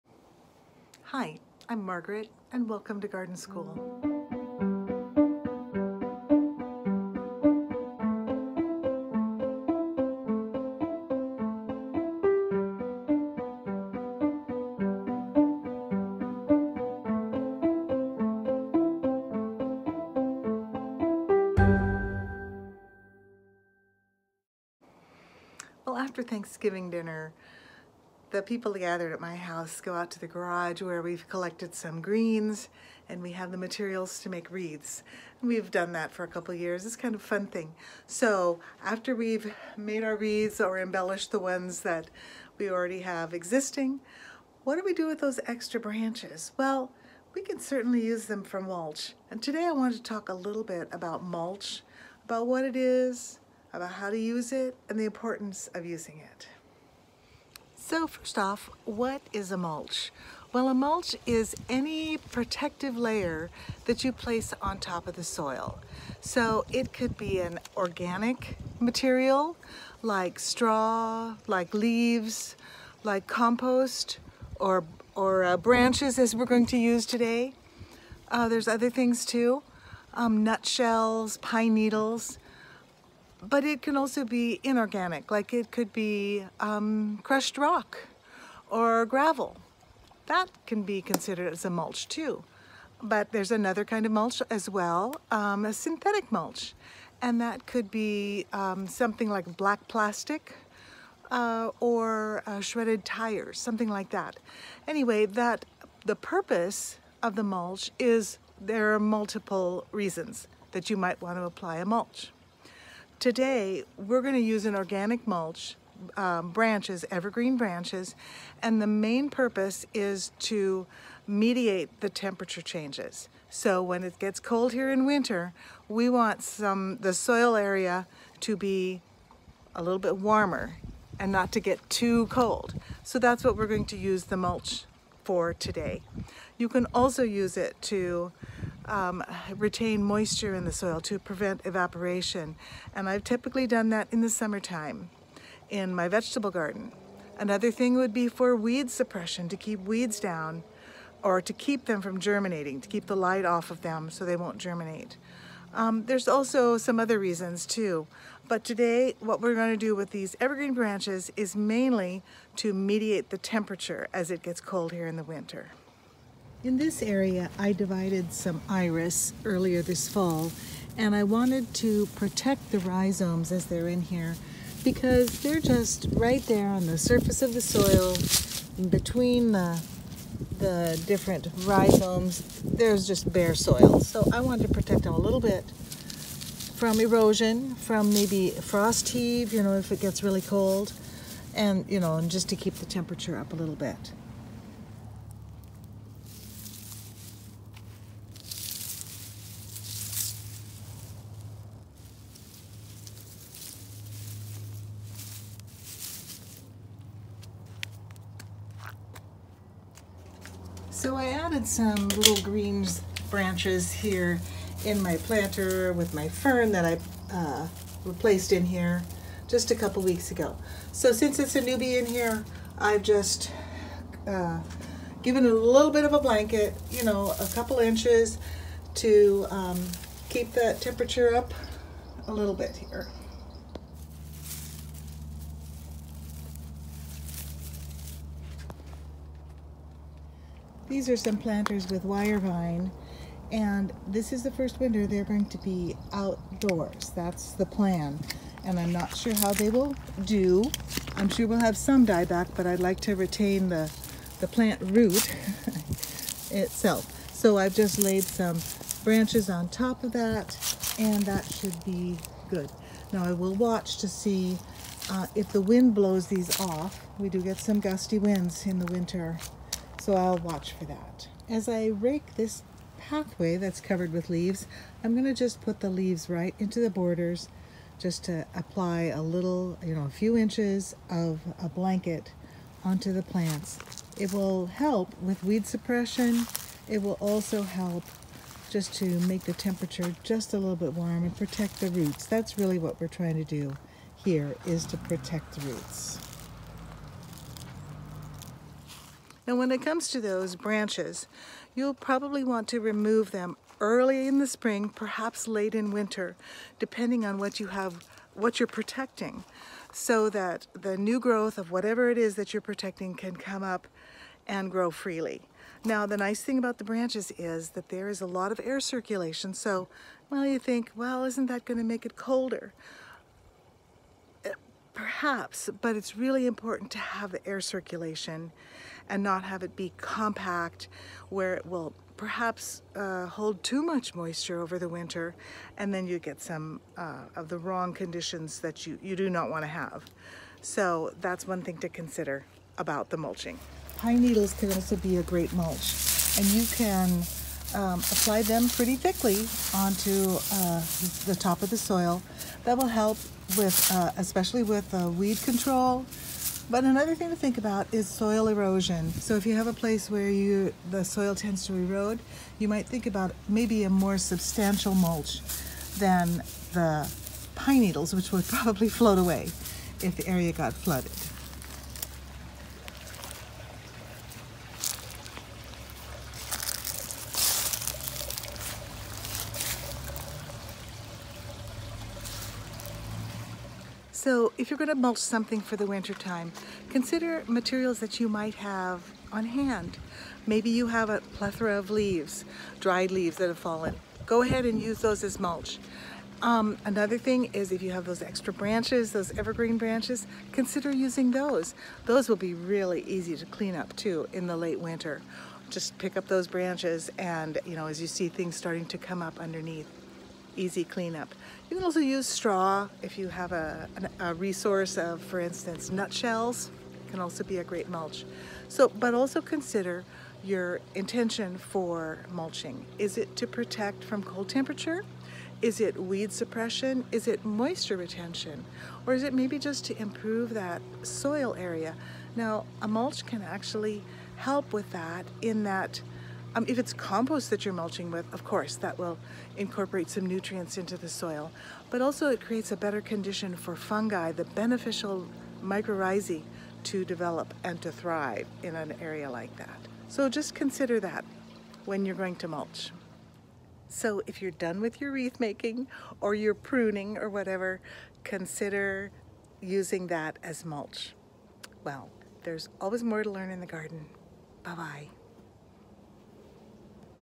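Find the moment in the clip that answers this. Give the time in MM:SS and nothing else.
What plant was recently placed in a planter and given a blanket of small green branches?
03:36.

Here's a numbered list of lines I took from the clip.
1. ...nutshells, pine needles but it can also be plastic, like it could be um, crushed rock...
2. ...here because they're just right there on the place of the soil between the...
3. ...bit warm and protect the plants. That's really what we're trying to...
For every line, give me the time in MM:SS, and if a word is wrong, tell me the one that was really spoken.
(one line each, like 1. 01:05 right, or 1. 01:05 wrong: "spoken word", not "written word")
1. 01:20 wrong: "inorganic", not "plastic"
2. 02:54 wrong: "surface", not "place"
3. 04:50 wrong: "roots", not "plants".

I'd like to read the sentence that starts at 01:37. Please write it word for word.
And that could be um, something like black plastic uh, or uh, shredded tires, something like that.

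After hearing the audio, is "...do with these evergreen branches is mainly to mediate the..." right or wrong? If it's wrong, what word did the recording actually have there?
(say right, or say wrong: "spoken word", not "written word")
right.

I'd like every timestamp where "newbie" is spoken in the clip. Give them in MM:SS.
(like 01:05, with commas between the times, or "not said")
03:41.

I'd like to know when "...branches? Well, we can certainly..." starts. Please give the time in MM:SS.
00:45.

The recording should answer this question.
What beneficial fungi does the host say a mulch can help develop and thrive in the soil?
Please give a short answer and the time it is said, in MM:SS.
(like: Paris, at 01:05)
mycorrhizae, at 07:25.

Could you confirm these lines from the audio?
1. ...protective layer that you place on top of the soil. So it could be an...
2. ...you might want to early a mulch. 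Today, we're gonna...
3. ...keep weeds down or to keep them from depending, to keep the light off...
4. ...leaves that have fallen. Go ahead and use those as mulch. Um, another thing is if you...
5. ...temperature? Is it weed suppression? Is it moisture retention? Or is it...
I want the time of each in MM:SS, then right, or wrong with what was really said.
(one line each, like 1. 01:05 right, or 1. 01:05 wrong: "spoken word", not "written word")
1. 01:02 right
2. 01:50 wrong: "apply", not "early"
3. 02:29 wrong: "germinating", not "depending"
4. 06:33 right
5. 07:04 right.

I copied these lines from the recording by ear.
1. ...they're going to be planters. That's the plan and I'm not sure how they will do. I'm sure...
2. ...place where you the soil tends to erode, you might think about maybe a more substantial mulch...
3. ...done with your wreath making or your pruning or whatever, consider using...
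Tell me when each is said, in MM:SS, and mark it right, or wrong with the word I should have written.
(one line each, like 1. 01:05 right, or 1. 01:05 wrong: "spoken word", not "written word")
1. 04:05 wrong: "outdoors", not "planters"
2. 05:59 right
3. 07:34 right.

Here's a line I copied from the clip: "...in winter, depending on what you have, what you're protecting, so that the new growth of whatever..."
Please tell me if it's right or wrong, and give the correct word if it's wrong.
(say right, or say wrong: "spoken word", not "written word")
right.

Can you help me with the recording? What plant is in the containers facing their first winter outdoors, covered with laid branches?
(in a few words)
wire vine.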